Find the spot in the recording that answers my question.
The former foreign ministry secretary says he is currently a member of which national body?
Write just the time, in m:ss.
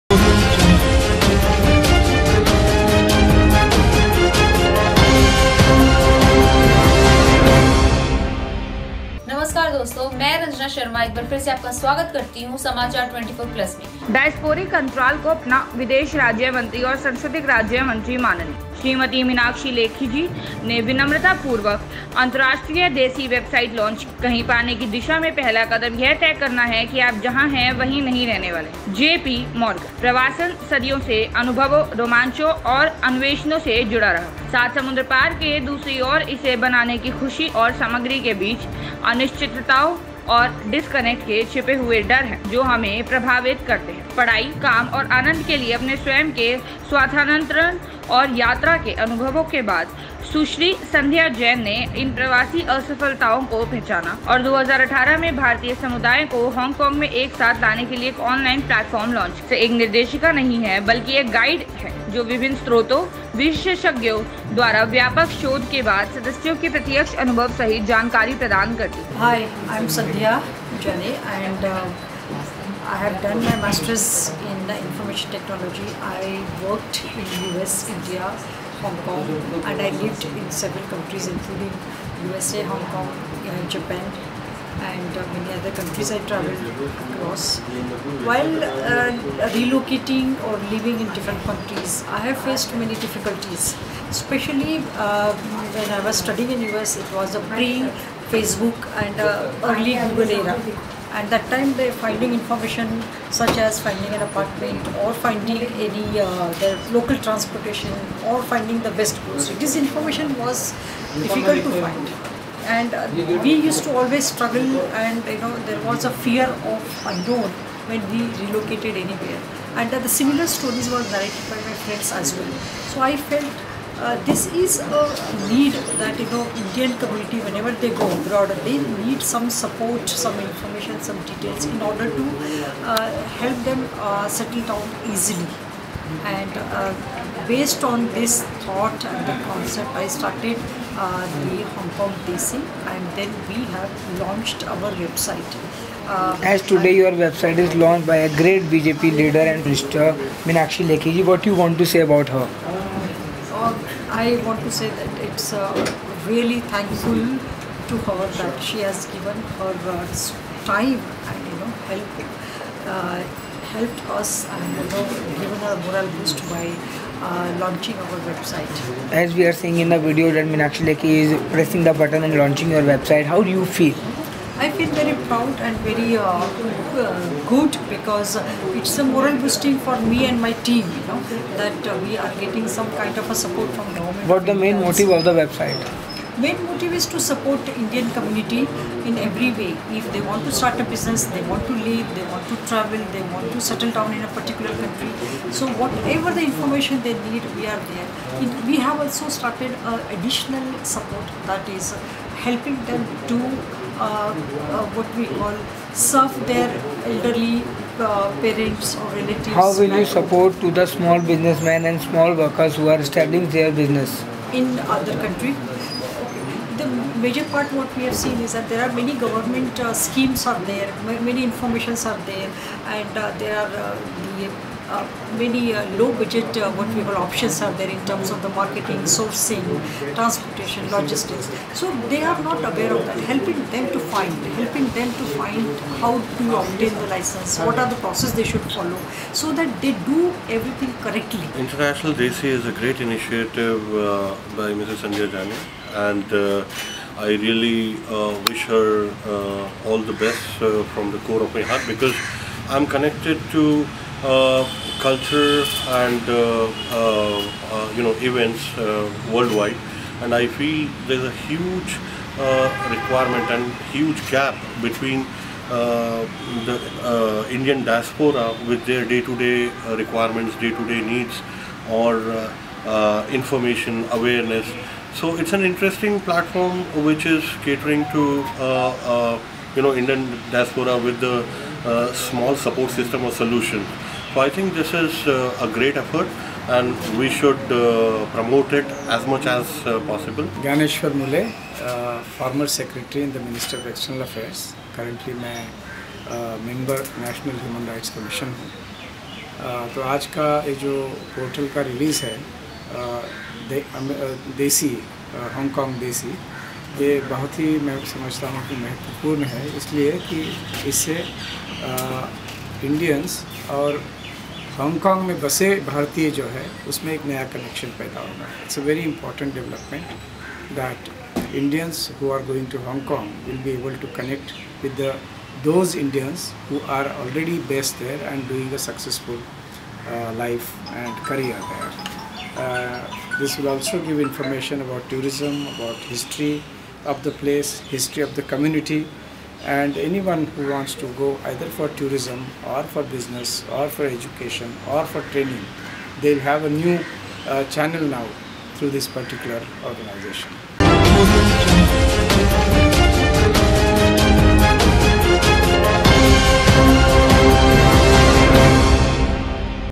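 4:57.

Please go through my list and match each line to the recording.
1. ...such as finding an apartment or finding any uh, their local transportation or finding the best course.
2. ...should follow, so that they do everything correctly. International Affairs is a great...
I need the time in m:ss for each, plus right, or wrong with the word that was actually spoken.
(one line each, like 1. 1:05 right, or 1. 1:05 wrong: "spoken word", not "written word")
1. 1:43 right
2. 3:58 wrong: "Desi", not "Affairs".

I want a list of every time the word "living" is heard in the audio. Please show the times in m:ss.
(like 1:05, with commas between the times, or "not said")
1:30.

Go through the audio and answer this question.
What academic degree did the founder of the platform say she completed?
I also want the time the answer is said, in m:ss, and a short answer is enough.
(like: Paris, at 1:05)
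Master's in information technology, at 1:13.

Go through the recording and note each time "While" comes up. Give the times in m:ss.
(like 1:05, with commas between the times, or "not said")
1:28.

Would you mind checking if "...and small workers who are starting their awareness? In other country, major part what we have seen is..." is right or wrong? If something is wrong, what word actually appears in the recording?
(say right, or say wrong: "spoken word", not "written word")
wrong: "business", not "awareness".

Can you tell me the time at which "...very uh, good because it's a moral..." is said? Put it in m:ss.
2:55.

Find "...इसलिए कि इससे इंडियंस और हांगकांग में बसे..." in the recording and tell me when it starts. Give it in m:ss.
5:09.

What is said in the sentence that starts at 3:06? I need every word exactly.
main motive is to support Indian community in every way.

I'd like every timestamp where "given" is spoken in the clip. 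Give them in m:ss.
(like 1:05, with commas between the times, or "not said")
2:39, 2:45.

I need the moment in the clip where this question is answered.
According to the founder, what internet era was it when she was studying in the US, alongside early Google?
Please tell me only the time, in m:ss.
1:37.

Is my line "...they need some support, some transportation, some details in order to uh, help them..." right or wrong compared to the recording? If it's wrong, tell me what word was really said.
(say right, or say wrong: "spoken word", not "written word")
wrong: "information", not "transportation".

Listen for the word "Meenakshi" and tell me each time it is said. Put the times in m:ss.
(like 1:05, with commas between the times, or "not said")
2:30, 2:50.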